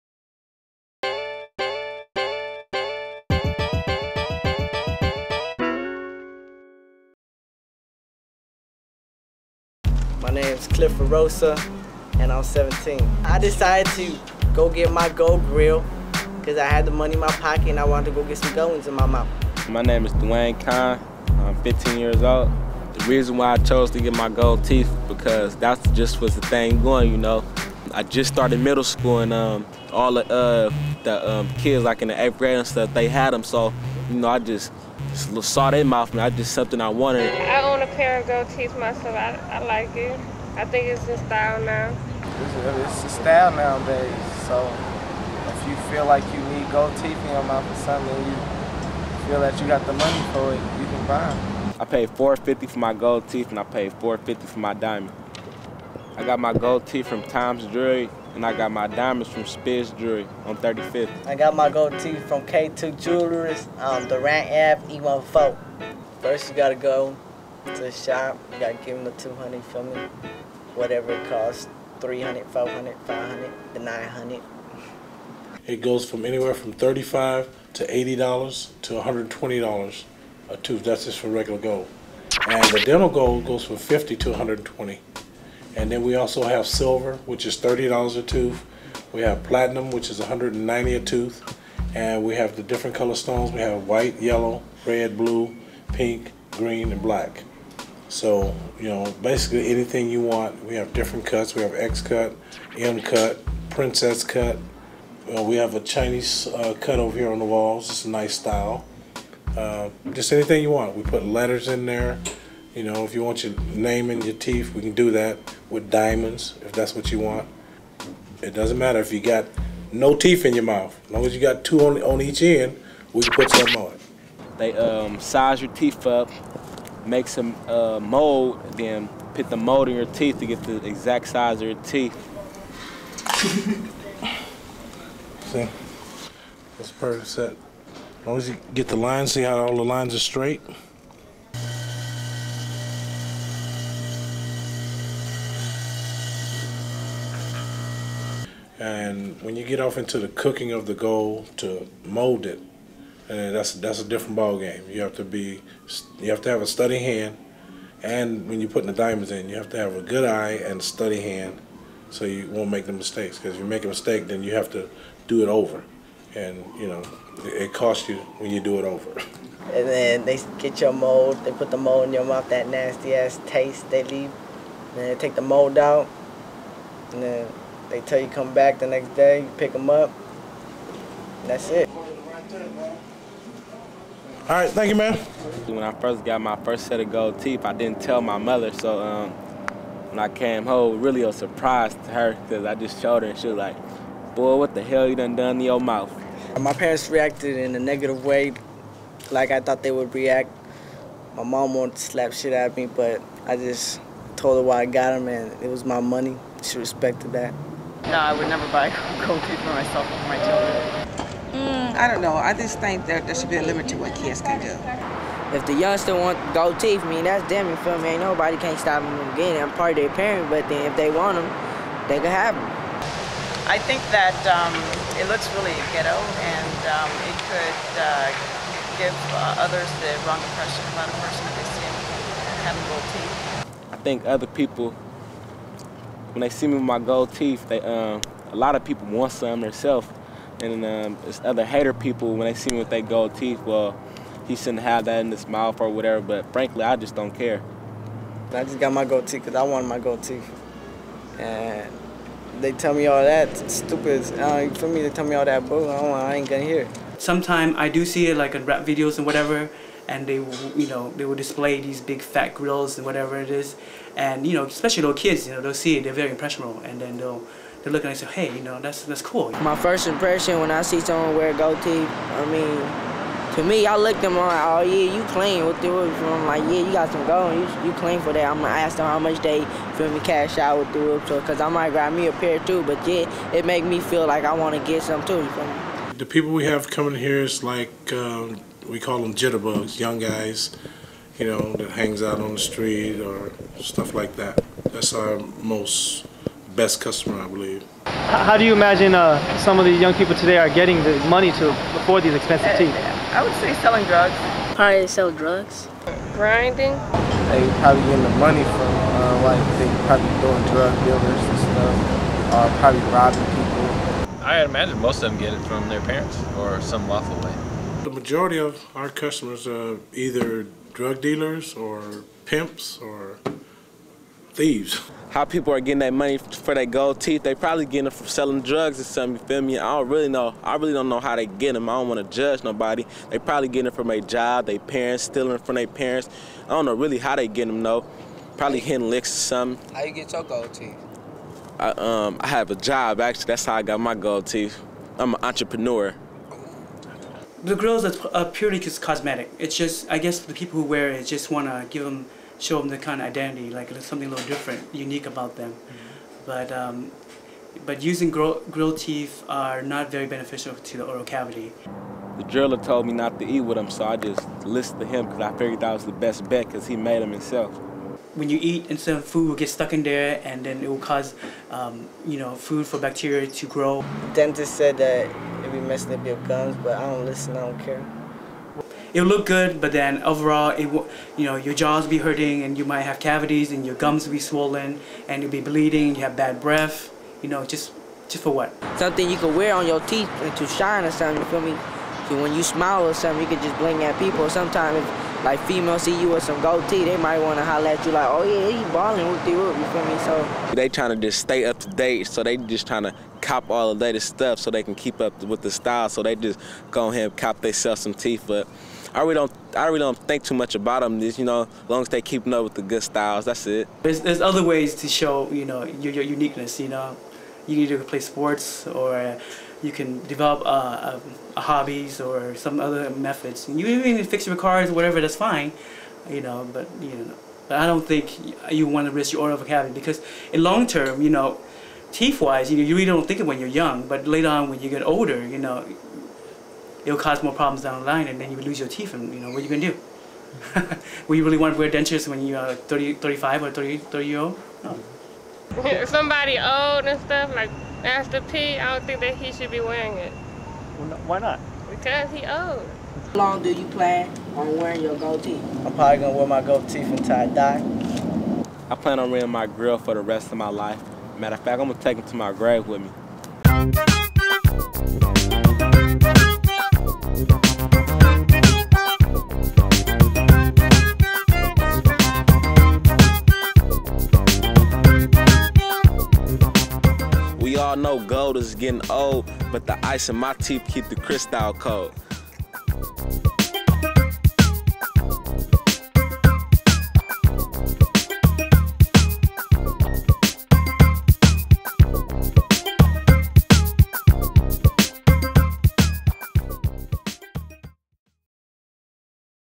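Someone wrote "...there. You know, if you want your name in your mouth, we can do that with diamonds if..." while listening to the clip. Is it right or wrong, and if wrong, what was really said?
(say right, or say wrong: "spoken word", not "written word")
wrong: "teeth", not "mouth".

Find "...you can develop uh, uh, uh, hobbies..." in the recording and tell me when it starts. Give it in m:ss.
6:59.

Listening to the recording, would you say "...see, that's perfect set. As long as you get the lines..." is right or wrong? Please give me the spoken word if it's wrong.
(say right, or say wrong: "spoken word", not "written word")
right.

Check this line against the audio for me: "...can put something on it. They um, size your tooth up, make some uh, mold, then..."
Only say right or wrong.
wrong.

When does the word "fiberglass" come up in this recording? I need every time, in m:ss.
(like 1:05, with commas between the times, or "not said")
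not said.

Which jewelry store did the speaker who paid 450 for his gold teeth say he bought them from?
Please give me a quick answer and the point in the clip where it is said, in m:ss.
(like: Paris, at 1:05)
Tom's Jewelry, at 0:57.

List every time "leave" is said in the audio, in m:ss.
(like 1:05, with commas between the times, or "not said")
2:54.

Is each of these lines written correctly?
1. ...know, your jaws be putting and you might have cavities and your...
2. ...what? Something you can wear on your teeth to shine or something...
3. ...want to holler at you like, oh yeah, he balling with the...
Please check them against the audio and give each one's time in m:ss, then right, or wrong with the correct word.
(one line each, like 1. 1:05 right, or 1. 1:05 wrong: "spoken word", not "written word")
1. 6:21 wrong: "hurting", not "putting"
2. 6:28 right
3. 6:37 right.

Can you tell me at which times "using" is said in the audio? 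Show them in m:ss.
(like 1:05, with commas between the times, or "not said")
5:58.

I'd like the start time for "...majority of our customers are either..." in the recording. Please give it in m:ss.
5:18.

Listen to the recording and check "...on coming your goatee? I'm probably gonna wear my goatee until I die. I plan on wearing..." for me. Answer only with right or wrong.
wrong.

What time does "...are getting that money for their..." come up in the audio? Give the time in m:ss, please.
5:25.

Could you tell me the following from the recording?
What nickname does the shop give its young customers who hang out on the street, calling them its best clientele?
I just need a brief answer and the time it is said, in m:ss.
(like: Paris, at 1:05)
jitterbugs, at 4:49.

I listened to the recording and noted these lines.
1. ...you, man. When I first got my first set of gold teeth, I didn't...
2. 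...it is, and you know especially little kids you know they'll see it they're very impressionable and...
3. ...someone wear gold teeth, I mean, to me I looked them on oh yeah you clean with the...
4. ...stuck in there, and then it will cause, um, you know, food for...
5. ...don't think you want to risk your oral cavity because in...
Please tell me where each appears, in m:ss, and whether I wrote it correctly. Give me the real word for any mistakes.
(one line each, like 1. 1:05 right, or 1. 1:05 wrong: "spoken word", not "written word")
1. 3:04 right
2. 4:23 right
3. 4:30 right
4. 6:09 right
5. 7:07 right.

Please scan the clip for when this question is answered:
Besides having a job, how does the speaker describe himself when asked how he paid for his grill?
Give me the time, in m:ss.
5:45.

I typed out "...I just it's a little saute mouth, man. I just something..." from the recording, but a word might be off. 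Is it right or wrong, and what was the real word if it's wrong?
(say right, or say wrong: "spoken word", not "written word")
right.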